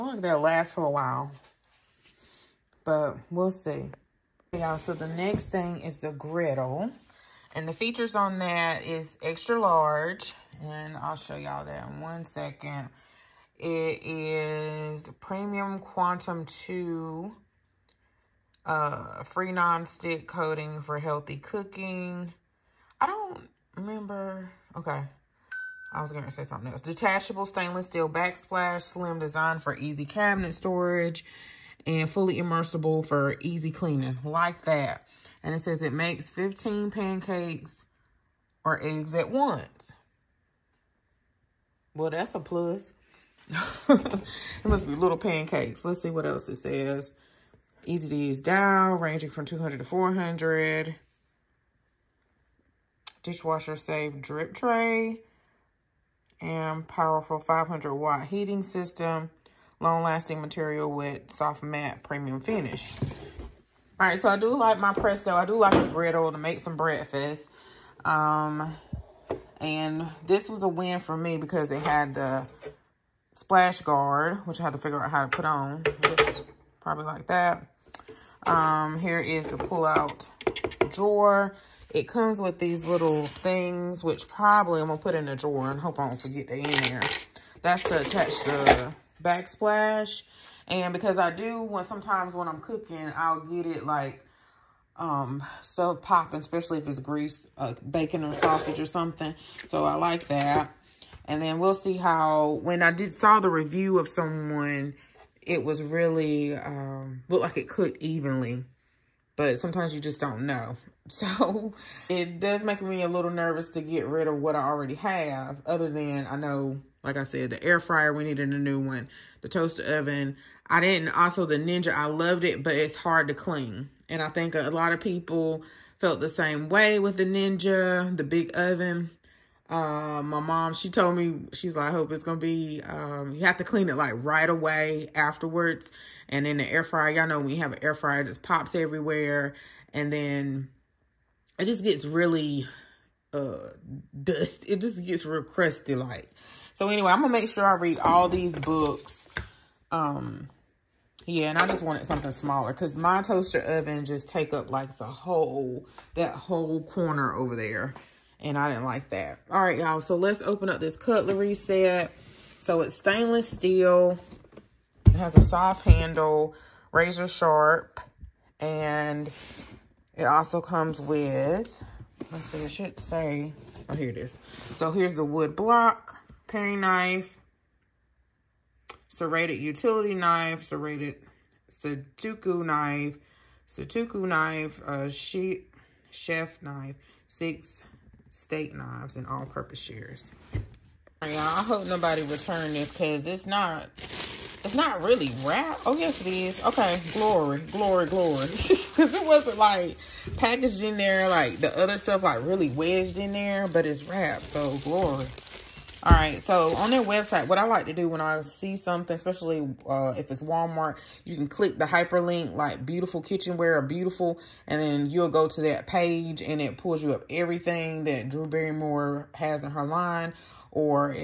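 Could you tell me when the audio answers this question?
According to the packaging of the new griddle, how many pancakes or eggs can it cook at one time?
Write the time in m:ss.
0:36.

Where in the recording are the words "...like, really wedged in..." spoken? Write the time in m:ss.
3:22.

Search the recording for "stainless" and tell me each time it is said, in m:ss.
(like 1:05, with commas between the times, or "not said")
0:27, 2:42.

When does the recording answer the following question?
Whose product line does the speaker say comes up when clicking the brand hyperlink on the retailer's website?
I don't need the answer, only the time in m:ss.
3:38.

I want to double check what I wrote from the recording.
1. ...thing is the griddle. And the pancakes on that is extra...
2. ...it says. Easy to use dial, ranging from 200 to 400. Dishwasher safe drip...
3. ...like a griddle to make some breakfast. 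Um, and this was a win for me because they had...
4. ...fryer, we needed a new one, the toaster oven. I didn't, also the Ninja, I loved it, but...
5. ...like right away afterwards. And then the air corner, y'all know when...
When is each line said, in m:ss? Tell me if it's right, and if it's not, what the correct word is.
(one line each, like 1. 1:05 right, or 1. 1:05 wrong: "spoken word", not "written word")
1. 0:05 wrong: "features", not "pancakes"
2. 0:46 right
3. 1:05 right
4. 1:57 right
5. 2:13 wrong: "fryer", not "corner".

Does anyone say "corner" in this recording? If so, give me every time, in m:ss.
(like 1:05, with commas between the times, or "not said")
2:36.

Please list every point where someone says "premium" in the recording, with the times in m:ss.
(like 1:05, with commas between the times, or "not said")
0:15, 1:02.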